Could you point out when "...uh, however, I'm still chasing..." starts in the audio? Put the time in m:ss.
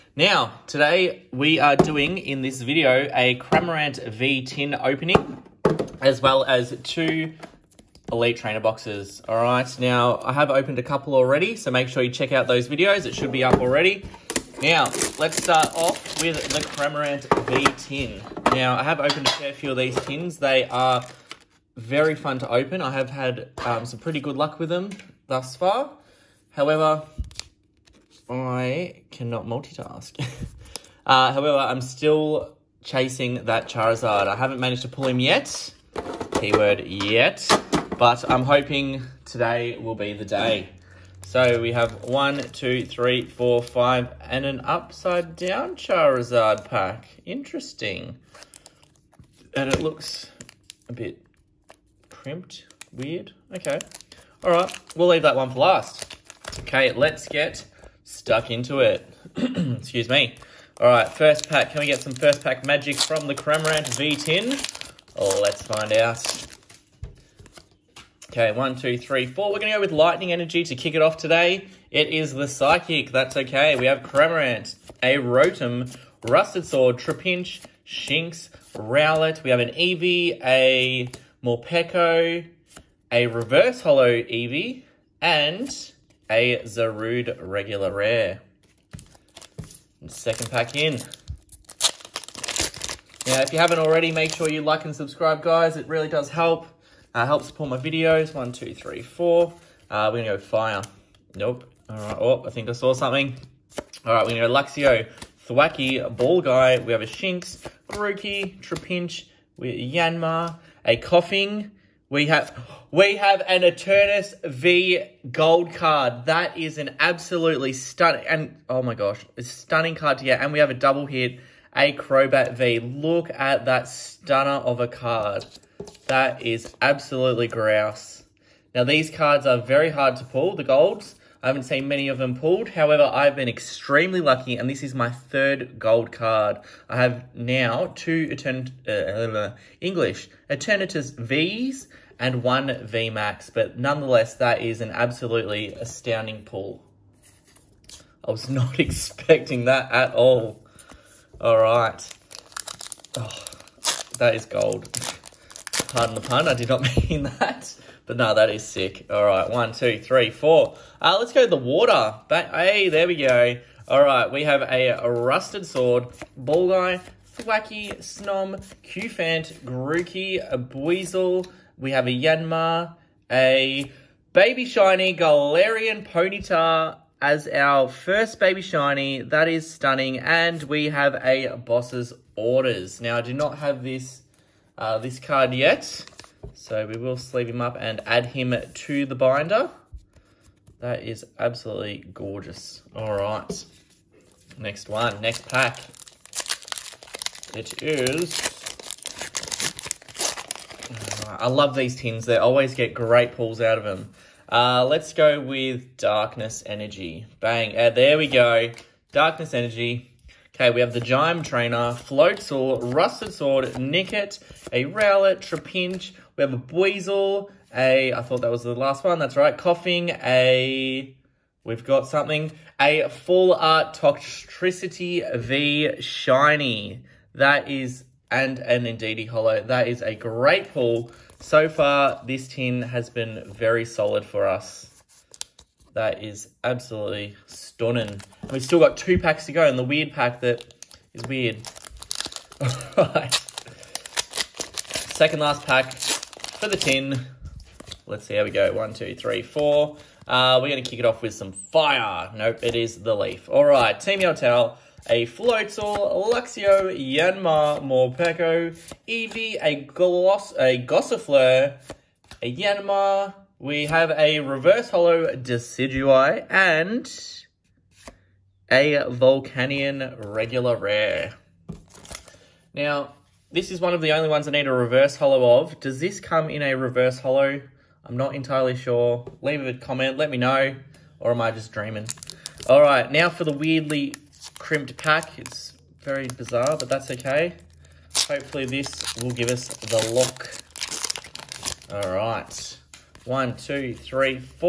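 0:31.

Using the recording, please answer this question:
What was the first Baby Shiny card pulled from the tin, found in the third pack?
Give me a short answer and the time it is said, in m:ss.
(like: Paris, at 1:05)
Galarian Ponyta, at 2:55.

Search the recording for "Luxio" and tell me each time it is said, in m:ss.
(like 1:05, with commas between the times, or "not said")
1:44, 4:16.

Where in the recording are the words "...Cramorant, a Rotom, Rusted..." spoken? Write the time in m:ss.
1:14.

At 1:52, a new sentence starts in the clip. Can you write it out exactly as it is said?
We have we have an Eternatus V gold card.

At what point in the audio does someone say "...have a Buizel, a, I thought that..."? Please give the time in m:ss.
3:36.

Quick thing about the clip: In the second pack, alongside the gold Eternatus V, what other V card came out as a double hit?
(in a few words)
Crobat V.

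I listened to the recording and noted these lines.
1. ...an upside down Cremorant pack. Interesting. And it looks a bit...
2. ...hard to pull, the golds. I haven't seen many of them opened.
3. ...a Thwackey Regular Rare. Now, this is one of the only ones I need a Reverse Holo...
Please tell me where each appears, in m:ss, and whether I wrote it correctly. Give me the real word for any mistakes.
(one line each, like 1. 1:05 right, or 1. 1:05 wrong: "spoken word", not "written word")
1. 0:44 wrong: "Charizard", not "Cremorant"
2. 2:09 wrong: "pulled", not "opened"
3. 4:28 wrong: "Volcanion", not "Thwackey".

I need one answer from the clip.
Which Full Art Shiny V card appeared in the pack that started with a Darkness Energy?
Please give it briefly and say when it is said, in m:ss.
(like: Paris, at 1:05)
Toxtricity V, at 3:43.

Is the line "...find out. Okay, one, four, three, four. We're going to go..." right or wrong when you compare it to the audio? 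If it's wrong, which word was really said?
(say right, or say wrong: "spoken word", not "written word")
wrong: "two", not "four".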